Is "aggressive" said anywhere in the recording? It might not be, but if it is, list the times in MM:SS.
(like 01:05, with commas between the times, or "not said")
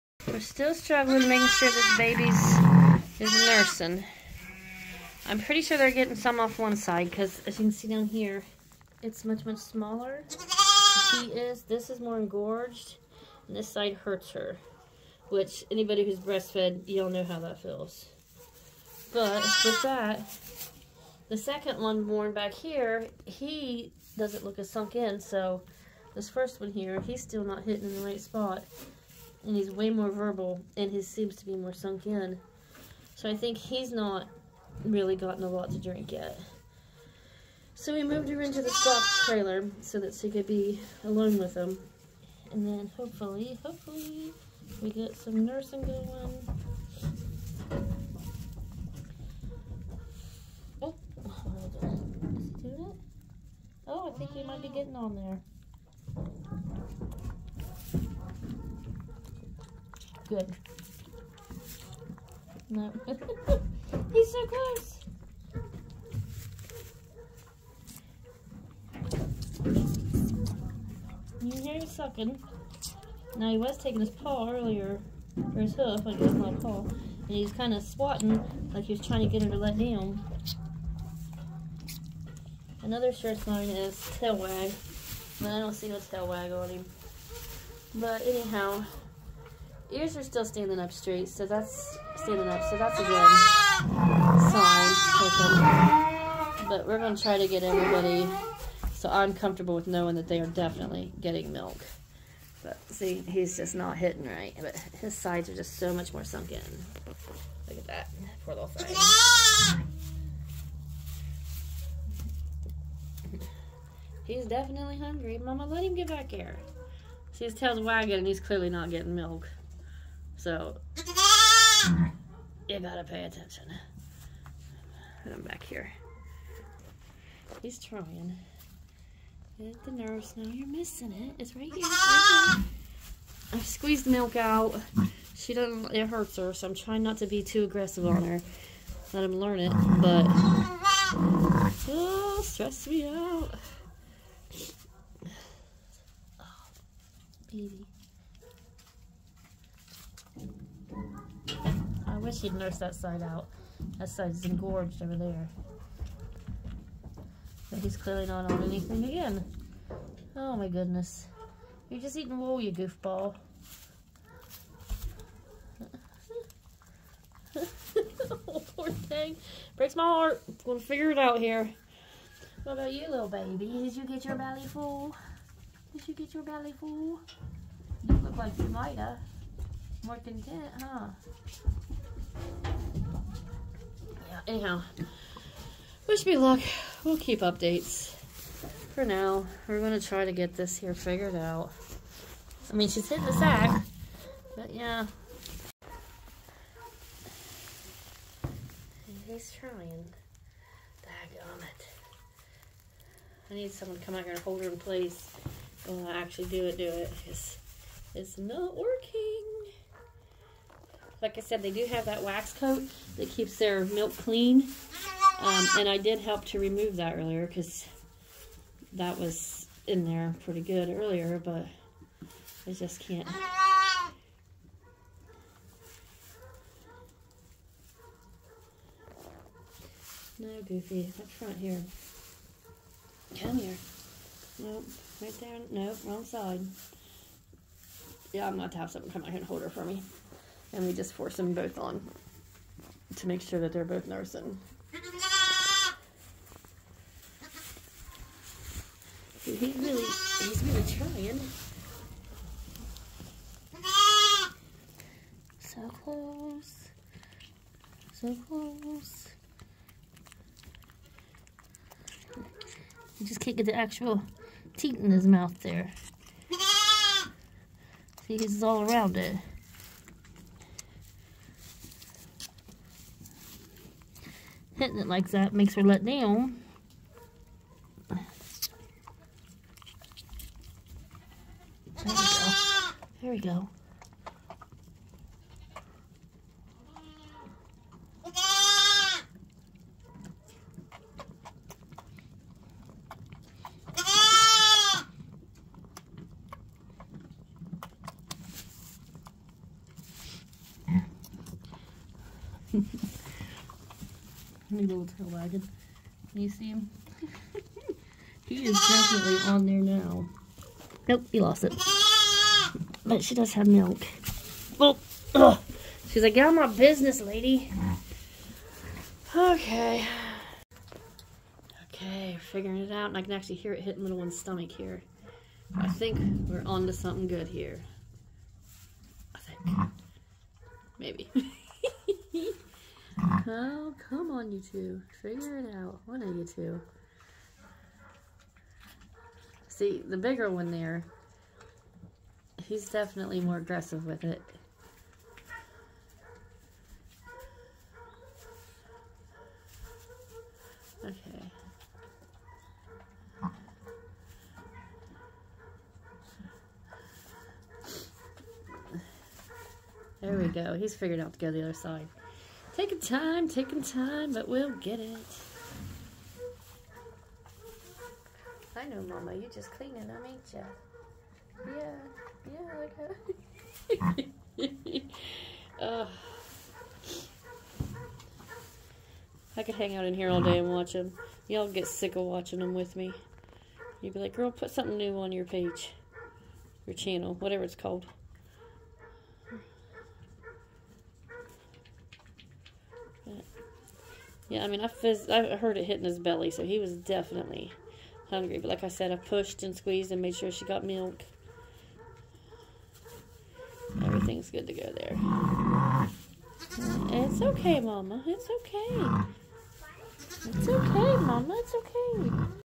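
02:17, 05:43.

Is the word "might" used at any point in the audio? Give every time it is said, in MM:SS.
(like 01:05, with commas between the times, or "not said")
00:54, 02:58.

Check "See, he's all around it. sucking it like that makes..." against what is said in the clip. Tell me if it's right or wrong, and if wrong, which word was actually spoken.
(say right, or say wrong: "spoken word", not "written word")
wrong: "hitting", not "sucking".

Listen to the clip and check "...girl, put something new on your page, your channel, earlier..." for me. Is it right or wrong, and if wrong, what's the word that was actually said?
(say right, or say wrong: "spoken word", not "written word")
wrong: "whatever", not "earlier".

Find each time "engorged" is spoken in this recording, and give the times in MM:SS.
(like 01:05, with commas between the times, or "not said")
00:12, 02:34.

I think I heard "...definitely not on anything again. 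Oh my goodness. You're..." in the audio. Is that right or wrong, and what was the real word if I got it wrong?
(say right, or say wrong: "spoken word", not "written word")
wrong: "clearly", not "definitely".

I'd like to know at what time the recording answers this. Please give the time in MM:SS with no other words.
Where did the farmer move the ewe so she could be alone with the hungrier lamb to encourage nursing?
00:38.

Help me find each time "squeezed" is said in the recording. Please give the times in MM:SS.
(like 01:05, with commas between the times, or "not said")
02:13, 06:39.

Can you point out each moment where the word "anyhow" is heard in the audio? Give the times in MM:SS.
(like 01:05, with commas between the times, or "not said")
01:28, 03:04.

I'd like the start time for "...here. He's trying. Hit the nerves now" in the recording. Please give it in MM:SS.
02:05.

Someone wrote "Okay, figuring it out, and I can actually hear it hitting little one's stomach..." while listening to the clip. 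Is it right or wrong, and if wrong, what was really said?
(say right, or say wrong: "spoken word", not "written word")
right.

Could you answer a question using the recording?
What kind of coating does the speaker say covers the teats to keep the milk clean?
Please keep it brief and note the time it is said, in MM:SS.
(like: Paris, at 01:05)
Wax coat, at 03:32.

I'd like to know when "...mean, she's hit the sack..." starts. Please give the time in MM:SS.
03:12.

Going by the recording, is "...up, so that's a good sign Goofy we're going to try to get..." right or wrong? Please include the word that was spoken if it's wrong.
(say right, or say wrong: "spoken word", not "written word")
wrong: "But", not "Goofy".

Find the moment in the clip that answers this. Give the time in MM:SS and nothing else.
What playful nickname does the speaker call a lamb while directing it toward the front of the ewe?
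03:50.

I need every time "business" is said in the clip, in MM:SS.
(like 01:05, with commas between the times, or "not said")
05:16.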